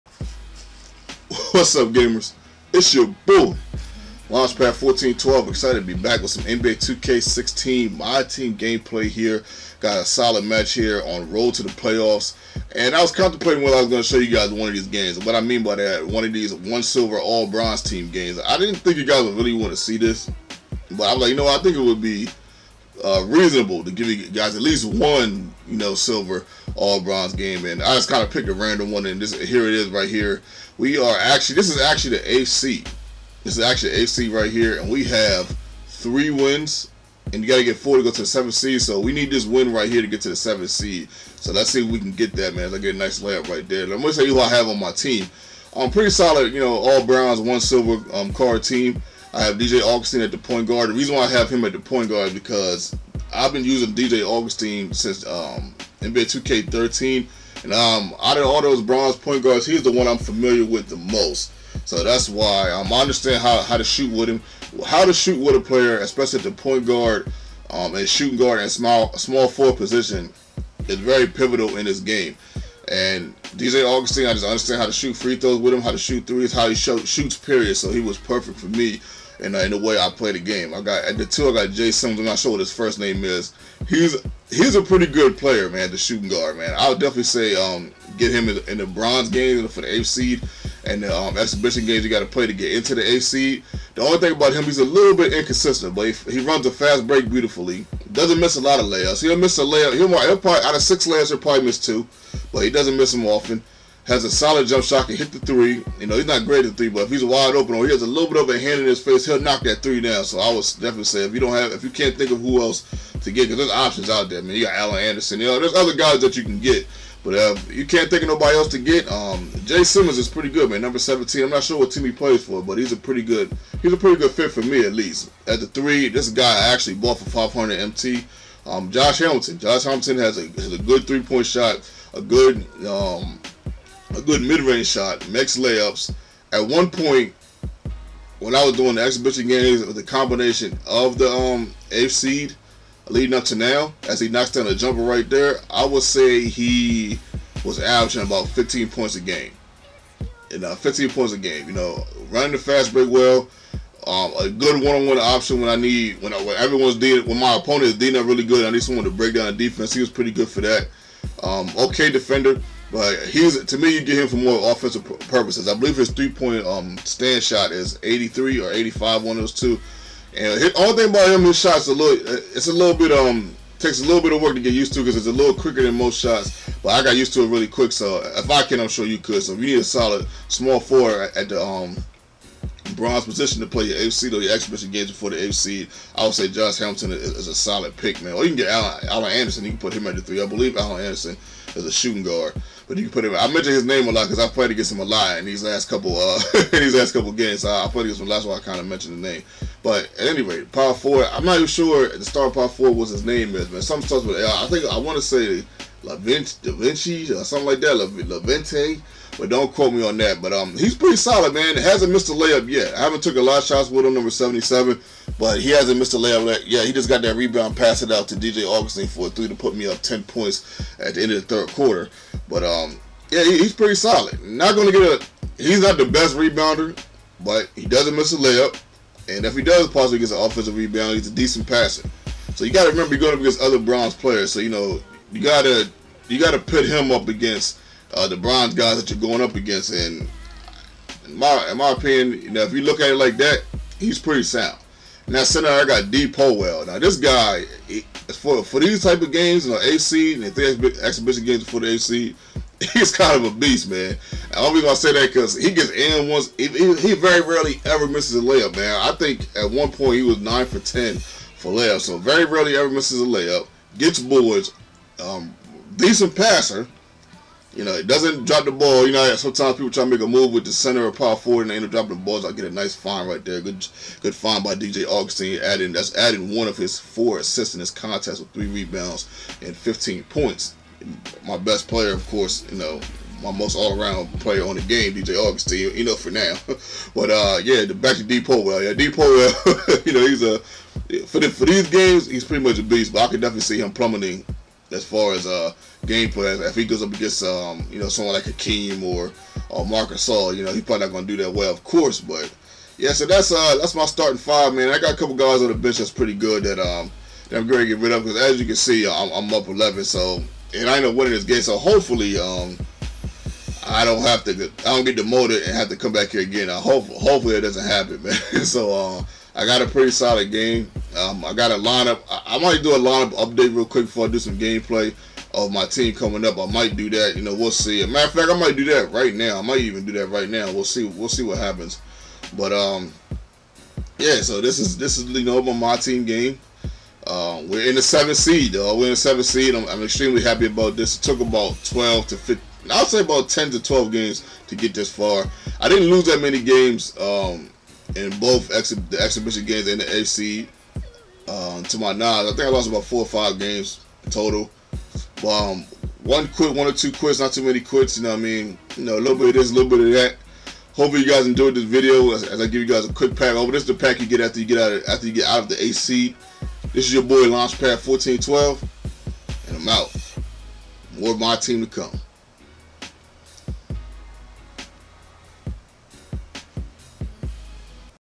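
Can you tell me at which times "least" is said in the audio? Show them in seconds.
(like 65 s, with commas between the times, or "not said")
24 s, 124 s.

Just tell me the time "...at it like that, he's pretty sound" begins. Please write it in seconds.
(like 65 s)
242 s.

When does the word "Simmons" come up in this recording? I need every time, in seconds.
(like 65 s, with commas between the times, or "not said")
119 s.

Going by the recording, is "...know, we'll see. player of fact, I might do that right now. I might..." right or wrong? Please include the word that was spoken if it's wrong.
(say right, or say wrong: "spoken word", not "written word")
wrong: "matter", not "player".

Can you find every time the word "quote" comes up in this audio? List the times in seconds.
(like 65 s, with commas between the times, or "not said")
209 s.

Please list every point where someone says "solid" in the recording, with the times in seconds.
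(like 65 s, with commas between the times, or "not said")
10 s, 46 s, 104 s, 179 s, 187 s, 211 s, 223 s, 320 s.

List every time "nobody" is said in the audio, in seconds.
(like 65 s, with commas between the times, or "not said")
118 s.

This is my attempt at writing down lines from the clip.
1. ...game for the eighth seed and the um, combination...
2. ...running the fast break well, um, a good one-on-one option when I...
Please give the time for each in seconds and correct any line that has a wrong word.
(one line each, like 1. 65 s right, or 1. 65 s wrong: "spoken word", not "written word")
1. 89 s wrong: "exhibition", not "combination"
2. 152 s right.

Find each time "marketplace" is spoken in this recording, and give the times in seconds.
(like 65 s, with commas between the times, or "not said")
not said.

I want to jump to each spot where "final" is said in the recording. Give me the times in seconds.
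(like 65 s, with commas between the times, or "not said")
not said.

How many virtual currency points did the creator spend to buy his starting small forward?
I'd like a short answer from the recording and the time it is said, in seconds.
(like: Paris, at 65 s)
500 MT, at 127 s.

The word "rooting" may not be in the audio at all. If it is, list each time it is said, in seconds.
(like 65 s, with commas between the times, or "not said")
not said.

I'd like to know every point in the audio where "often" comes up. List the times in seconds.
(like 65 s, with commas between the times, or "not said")
103 s.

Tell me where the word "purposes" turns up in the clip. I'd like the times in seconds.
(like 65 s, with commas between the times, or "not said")
165 s.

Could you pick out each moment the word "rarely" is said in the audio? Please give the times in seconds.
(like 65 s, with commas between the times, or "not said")
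257 s, 262 s.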